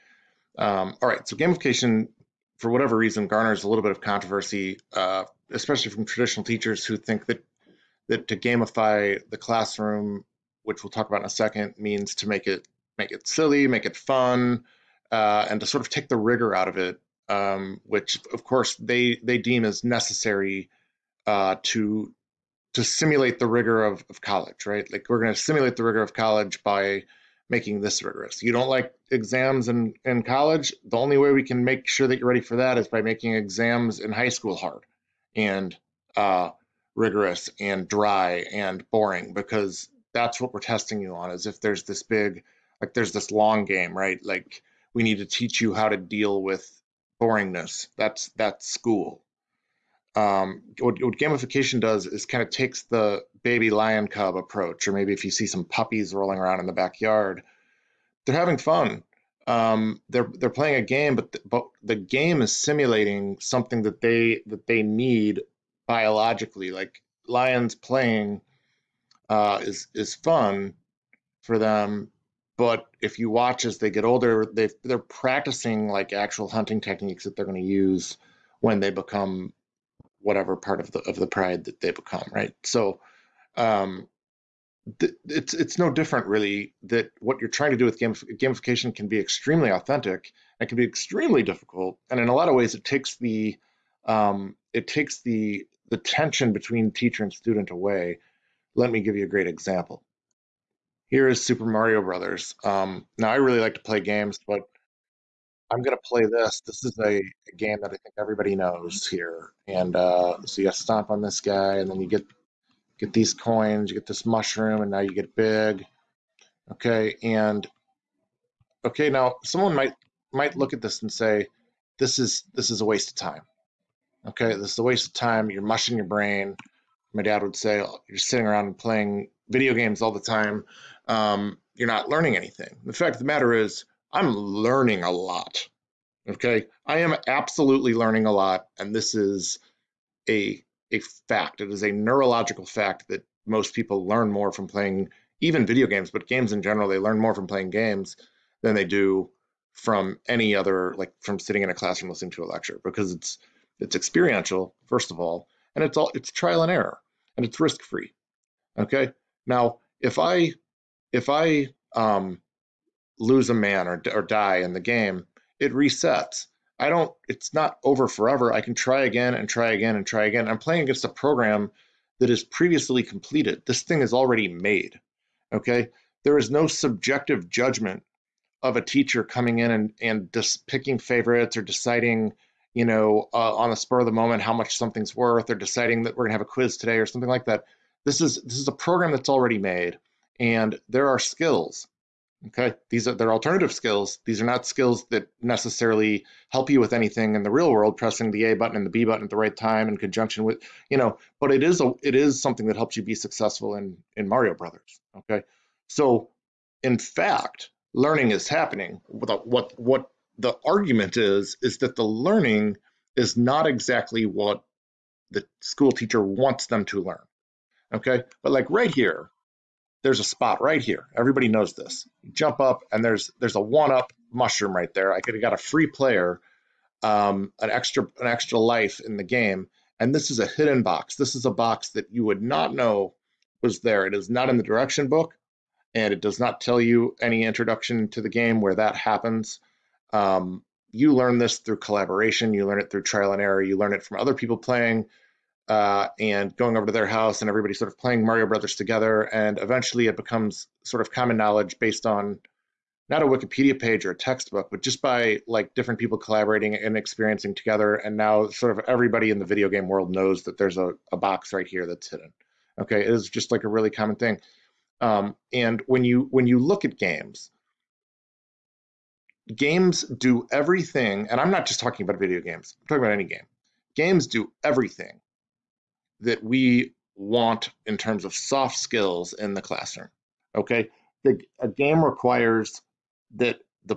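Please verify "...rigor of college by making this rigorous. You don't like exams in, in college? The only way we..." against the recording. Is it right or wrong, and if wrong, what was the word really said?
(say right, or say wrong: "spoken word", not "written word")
right.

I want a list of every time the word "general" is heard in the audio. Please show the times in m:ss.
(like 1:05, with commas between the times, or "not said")
2:26.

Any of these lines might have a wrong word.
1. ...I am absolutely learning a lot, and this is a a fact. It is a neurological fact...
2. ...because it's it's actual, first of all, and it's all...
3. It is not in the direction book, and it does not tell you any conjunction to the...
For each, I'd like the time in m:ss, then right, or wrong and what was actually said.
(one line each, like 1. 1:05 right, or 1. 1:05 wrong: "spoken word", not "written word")
1. 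2:16 right
2. 2:32 wrong: "experiential", not "actual"
3. 3:54 wrong: "introduction", not "conjunction".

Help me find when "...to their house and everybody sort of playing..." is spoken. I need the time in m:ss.
4:06.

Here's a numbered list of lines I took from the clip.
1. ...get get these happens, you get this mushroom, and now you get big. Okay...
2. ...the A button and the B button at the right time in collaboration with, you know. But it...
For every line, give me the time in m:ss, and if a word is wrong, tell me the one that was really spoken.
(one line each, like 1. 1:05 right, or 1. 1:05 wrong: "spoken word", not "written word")
1. 1:52 wrong: "coins", not "happens"
2. 3:18 wrong: "conjunction", not "collaboration".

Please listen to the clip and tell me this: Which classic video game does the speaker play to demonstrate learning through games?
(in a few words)
Super Mario Brothers.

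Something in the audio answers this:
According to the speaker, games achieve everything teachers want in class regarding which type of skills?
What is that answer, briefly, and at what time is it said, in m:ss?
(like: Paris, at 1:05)
Soft skills, at 4:38.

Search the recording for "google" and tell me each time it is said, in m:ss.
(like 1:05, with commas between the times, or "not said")
not said.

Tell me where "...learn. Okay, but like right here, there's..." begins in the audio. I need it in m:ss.
3:37.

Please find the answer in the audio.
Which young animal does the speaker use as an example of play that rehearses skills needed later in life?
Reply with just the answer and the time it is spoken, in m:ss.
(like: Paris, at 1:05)
Baby lion cub, at 0:53.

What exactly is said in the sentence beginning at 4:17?
And now sort of everybody in the video game world knows that there's a, a box right here that's hidden.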